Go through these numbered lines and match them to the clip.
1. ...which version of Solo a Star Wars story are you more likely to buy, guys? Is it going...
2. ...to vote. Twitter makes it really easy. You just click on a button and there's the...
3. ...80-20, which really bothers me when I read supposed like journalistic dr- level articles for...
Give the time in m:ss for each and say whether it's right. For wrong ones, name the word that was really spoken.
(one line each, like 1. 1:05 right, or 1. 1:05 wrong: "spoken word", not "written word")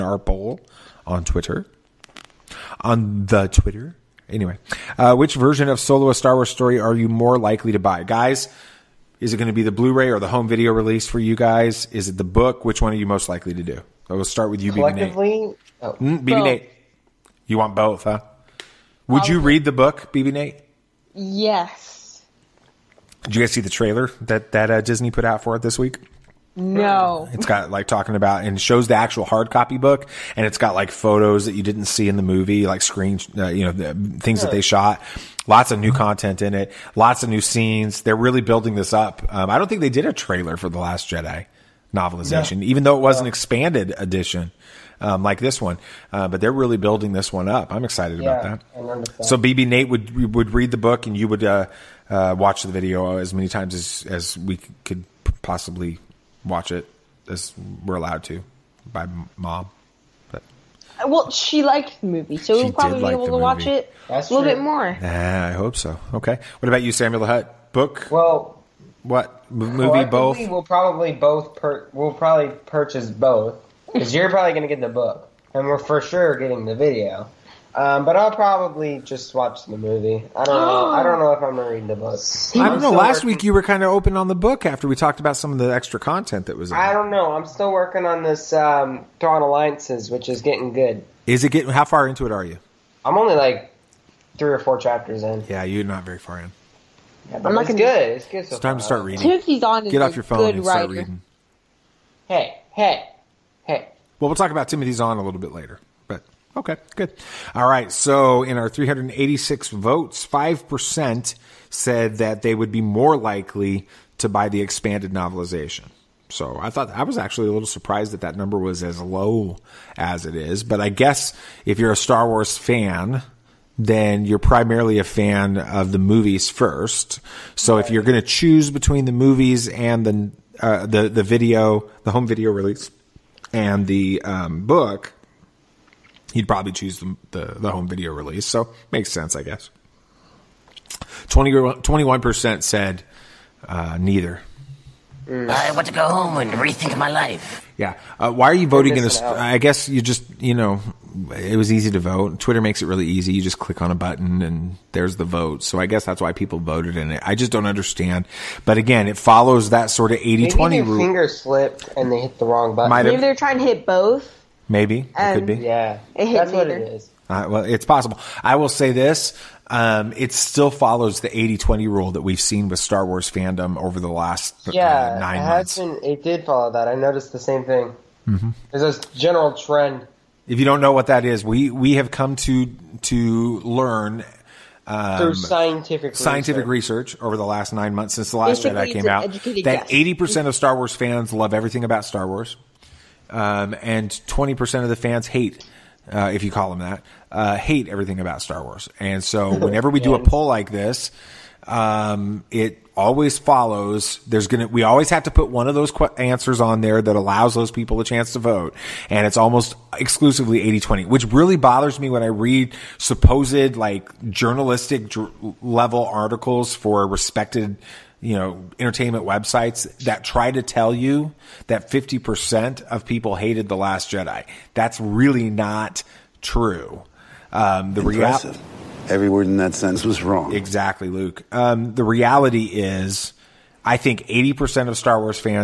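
1. 0:05 right
2. 2:31 right
3. 3:30 right.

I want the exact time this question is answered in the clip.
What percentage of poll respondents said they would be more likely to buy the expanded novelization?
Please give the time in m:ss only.
1:50.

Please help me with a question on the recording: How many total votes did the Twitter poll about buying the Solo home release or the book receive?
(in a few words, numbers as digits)
386.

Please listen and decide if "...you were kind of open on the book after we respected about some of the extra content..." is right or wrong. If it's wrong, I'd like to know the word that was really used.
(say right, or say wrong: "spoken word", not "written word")
wrong: "talked", not "respected".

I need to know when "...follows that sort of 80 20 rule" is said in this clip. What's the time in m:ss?
2:39.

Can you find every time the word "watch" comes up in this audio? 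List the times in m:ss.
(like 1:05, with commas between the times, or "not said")
0:52, 0:56, 1:03, 1:19.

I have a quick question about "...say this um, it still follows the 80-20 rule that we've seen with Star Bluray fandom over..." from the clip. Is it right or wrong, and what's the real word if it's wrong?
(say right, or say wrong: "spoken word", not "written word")
wrong: "Wars", not "Bluray".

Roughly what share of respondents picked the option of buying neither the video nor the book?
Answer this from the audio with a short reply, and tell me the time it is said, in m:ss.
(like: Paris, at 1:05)
21%, at 2:21.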